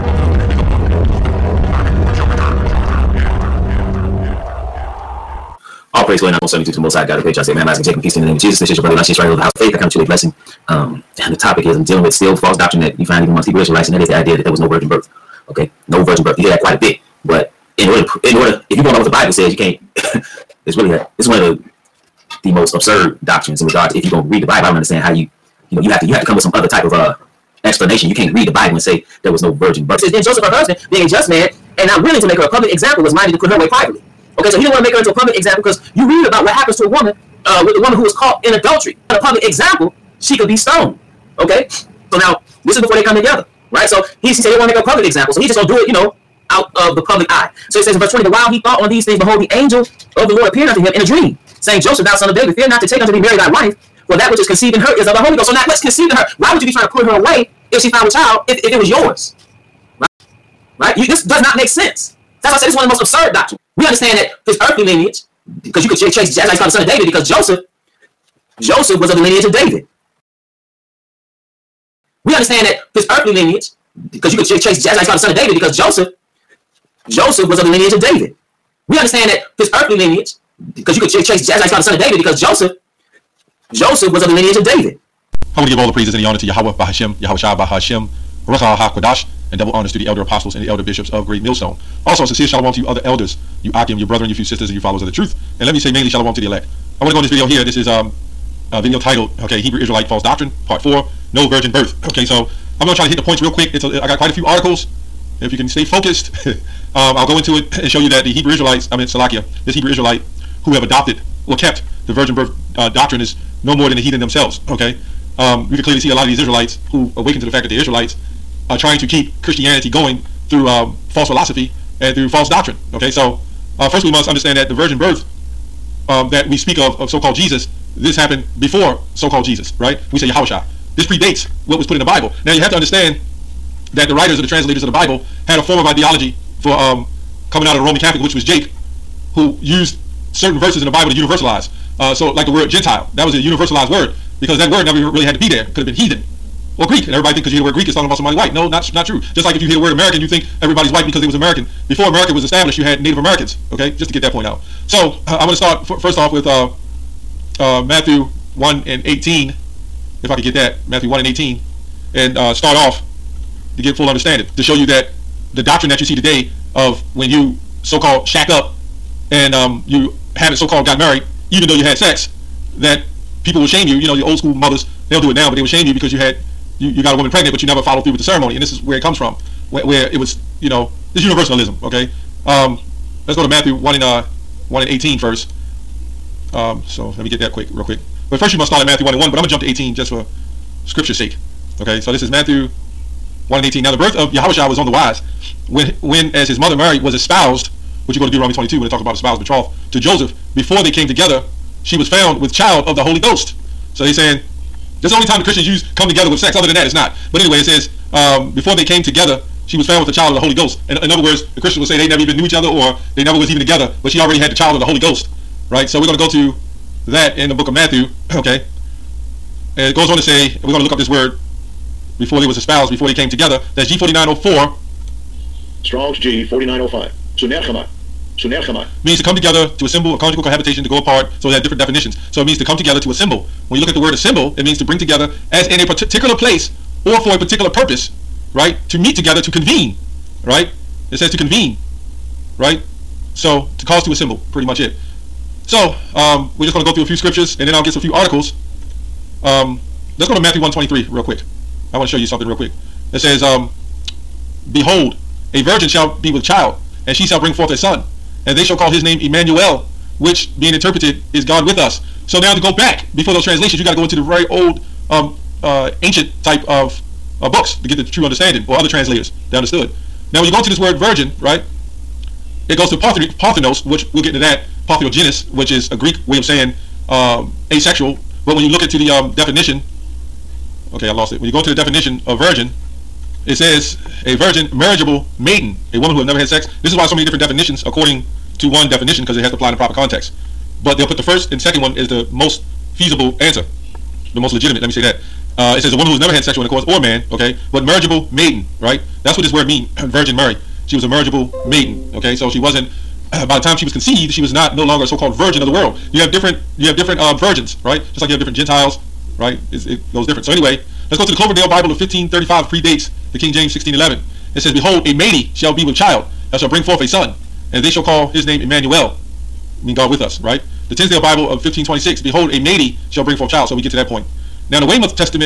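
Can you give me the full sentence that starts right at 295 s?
Uh, it says a woman who's never had sexual intercourse or man, okay, but marriageable maiden, right?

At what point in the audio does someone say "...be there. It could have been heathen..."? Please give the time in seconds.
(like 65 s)
145 s.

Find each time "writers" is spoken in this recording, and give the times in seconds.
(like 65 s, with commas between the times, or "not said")
134 s.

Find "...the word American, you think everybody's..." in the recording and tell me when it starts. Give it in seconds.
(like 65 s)
149 s.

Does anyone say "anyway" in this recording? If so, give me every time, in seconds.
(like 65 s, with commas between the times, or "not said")
207 s, 310 s.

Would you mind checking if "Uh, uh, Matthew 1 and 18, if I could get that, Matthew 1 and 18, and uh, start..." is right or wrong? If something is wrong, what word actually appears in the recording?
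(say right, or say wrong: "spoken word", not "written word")
right.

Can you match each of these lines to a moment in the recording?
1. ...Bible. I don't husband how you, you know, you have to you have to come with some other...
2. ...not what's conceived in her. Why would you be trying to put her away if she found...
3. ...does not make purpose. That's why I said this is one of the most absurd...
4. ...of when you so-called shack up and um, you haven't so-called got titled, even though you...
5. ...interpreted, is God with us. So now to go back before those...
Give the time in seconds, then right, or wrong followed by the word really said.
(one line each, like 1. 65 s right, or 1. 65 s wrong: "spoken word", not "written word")
1. 24 s wrong: "understand", not "husband"
2. 55 s right
3. 61 s wrong: "sense", not "purpose"
4. 166 s wrong: "married", not "titled"
5. 260 s right.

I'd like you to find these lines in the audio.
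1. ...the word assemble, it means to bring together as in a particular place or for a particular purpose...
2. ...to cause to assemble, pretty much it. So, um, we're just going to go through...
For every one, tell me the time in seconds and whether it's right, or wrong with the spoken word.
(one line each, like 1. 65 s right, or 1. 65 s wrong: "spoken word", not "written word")
1. 233 s right
2. 243 s right.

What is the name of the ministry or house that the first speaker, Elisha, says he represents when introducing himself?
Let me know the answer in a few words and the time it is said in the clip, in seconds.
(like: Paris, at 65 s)
House of Faith, at 9 s.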